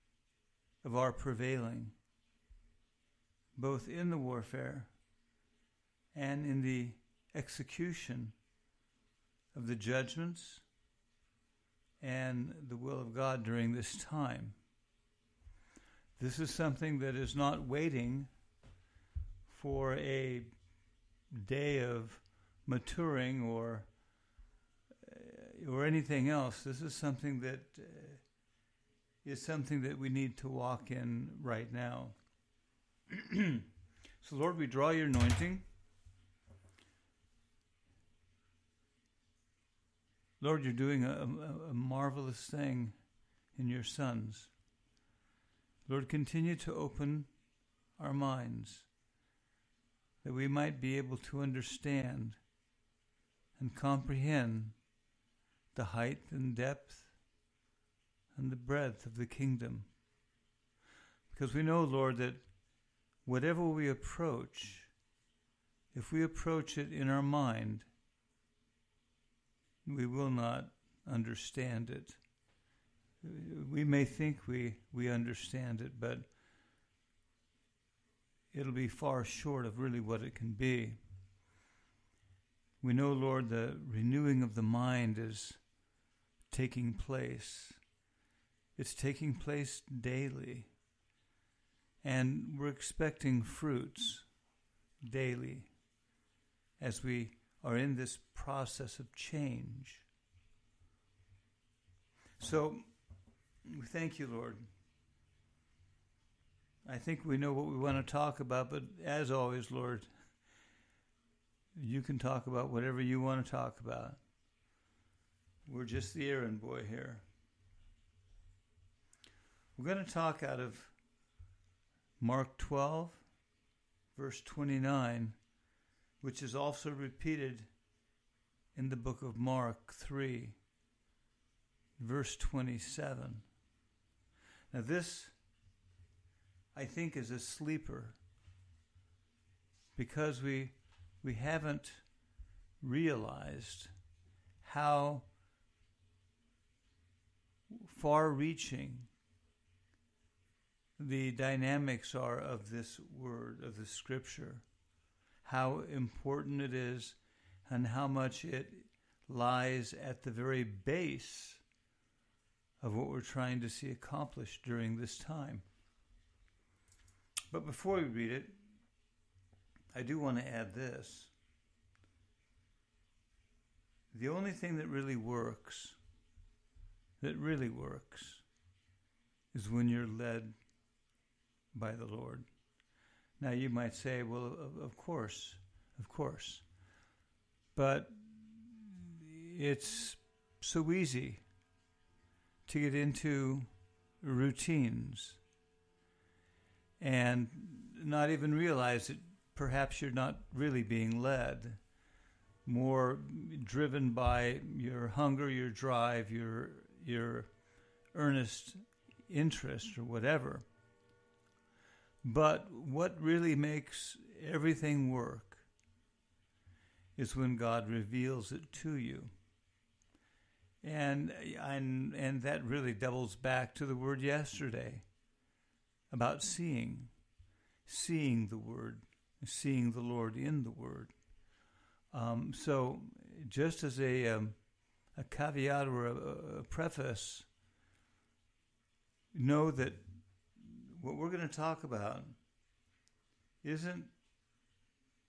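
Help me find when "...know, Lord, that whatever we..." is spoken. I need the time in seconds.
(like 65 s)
61 s.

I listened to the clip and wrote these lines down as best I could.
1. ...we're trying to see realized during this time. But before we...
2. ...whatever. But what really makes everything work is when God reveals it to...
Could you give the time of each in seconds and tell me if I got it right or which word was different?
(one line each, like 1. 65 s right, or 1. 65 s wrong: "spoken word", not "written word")
1. 163 s wrong: "accomplished", not "realized"
2. 210 s right.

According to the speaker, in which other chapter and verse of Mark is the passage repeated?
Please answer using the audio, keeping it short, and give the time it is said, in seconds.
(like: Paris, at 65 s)
Mark 3:27, at 129 s.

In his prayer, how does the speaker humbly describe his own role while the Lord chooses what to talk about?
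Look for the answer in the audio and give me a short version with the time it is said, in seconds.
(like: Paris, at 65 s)
the errand boy, at 116 s.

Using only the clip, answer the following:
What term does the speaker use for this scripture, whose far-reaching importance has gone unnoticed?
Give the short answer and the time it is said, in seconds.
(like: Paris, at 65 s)
a sleeper, at 137 s.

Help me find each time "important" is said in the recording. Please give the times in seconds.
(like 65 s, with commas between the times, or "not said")
155 s.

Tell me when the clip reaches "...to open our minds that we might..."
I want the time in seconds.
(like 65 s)
46 s.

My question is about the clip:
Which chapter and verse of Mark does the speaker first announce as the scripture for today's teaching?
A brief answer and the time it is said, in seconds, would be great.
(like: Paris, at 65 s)
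Mark 12:29, at 122 s.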